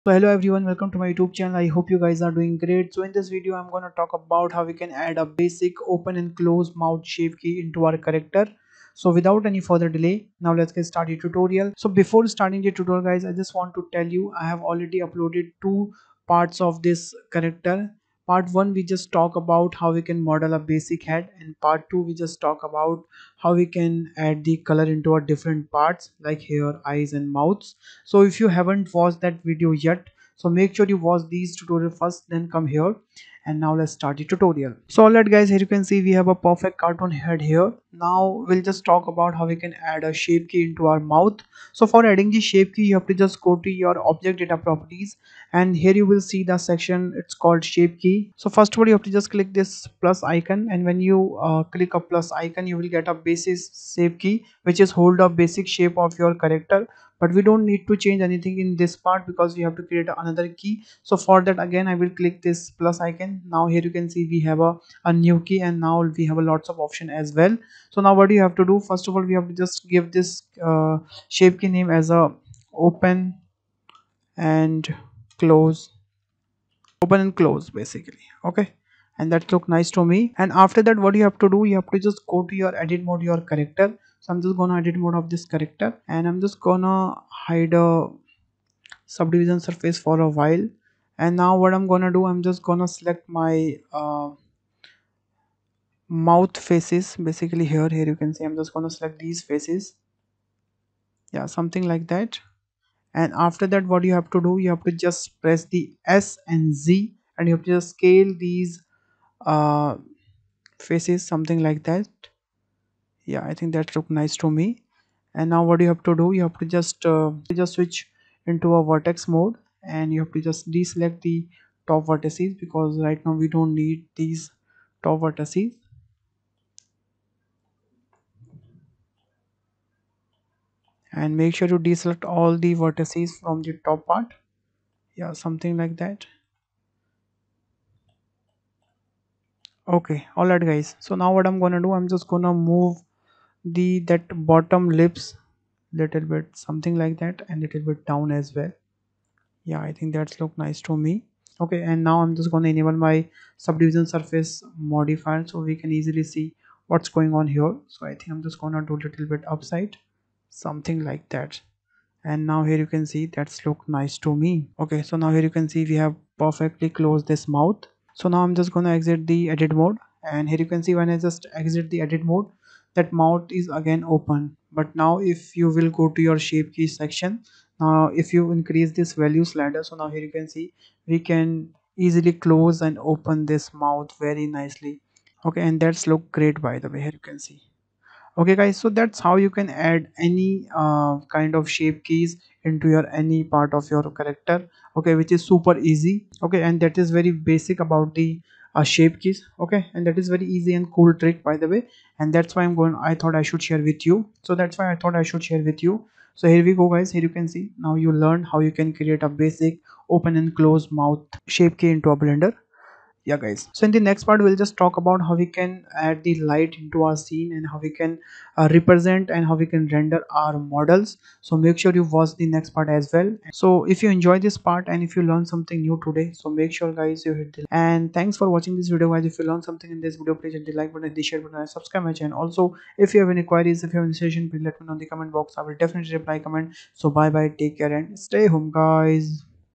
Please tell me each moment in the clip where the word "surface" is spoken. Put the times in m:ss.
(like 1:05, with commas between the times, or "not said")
1:29, 2:34.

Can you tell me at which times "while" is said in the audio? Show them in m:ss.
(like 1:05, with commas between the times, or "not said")
1:30.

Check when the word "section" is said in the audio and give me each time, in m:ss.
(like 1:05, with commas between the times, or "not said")
0:46, 2:56.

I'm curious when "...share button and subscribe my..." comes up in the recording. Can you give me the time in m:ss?
3:51.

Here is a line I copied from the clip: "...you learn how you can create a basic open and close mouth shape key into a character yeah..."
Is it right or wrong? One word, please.
wrong.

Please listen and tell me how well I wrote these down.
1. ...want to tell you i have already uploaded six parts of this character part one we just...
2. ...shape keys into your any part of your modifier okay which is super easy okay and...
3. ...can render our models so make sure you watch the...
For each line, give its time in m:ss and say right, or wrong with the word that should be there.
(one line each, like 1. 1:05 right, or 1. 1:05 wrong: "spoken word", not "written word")
1. 0:13 wrong: "two", not "six"
2. 3:11 wrong: "character", not "modifier"
3. 3:39 right.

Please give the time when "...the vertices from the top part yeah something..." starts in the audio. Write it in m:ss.
2:12.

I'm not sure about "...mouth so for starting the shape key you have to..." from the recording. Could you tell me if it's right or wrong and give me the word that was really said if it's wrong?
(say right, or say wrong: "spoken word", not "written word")
wrong: "adding", not "starting".